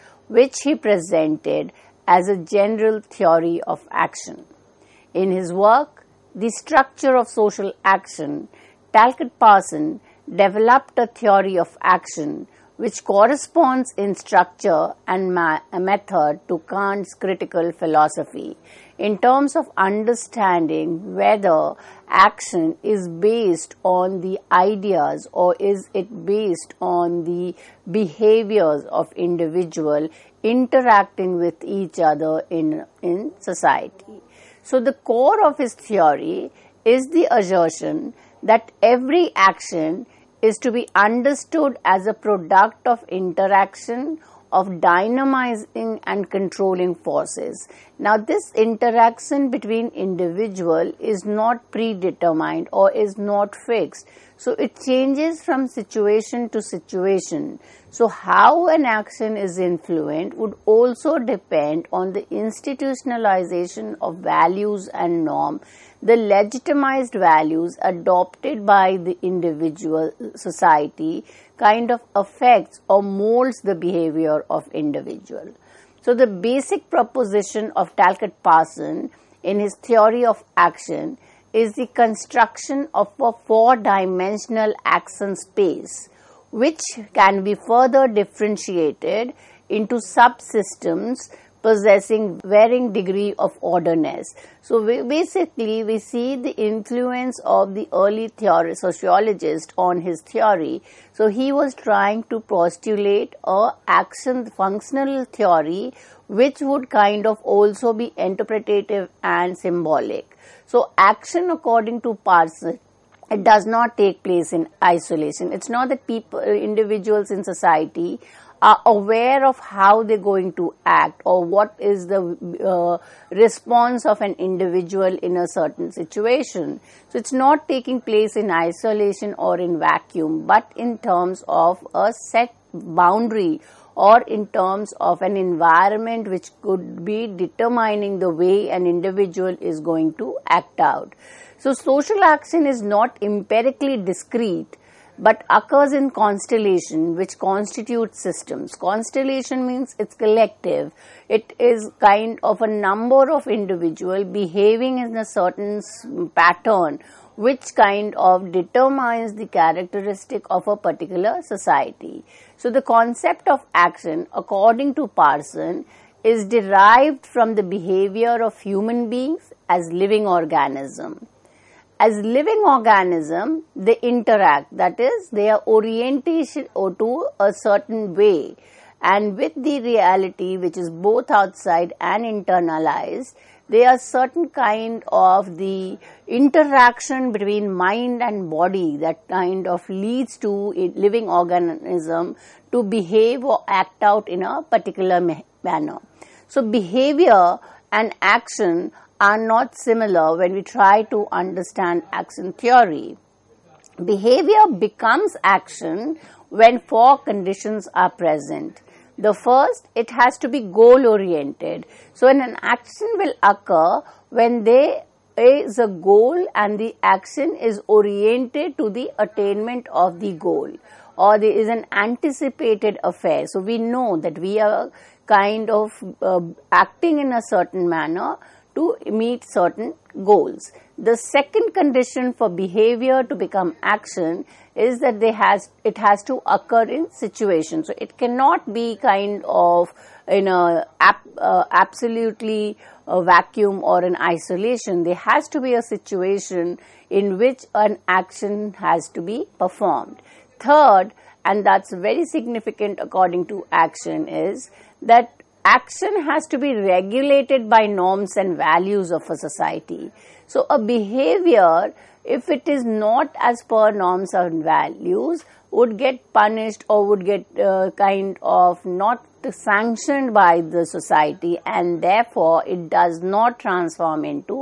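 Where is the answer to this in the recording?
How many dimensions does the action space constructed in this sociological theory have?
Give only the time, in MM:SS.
01:23.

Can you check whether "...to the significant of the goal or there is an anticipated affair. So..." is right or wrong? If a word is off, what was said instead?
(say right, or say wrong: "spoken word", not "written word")
wrong: "attainment", not "significant".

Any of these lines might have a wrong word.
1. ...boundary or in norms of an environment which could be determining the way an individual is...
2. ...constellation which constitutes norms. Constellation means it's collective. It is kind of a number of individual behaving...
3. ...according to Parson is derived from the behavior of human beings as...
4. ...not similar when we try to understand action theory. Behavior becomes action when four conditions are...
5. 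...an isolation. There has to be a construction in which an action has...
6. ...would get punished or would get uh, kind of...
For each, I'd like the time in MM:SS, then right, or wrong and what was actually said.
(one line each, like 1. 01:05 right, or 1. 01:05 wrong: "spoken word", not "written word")
1. 02:12 wrong: "terms", not "norms"
2. 02:26 wrong: "systems", not "norms"
3. 02:44 right
4. 03:19 right
5. 04:04 wrong: "situation", not "construction"
6. 04:25 right.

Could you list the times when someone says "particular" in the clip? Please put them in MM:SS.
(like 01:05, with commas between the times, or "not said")
02:40, 03:14.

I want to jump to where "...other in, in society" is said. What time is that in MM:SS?
00:31.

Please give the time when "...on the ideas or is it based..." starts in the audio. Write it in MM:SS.
00:23.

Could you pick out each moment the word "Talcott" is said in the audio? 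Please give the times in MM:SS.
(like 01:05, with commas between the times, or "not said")
00:08, 01:17.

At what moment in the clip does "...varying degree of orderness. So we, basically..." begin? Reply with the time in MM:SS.
01:32.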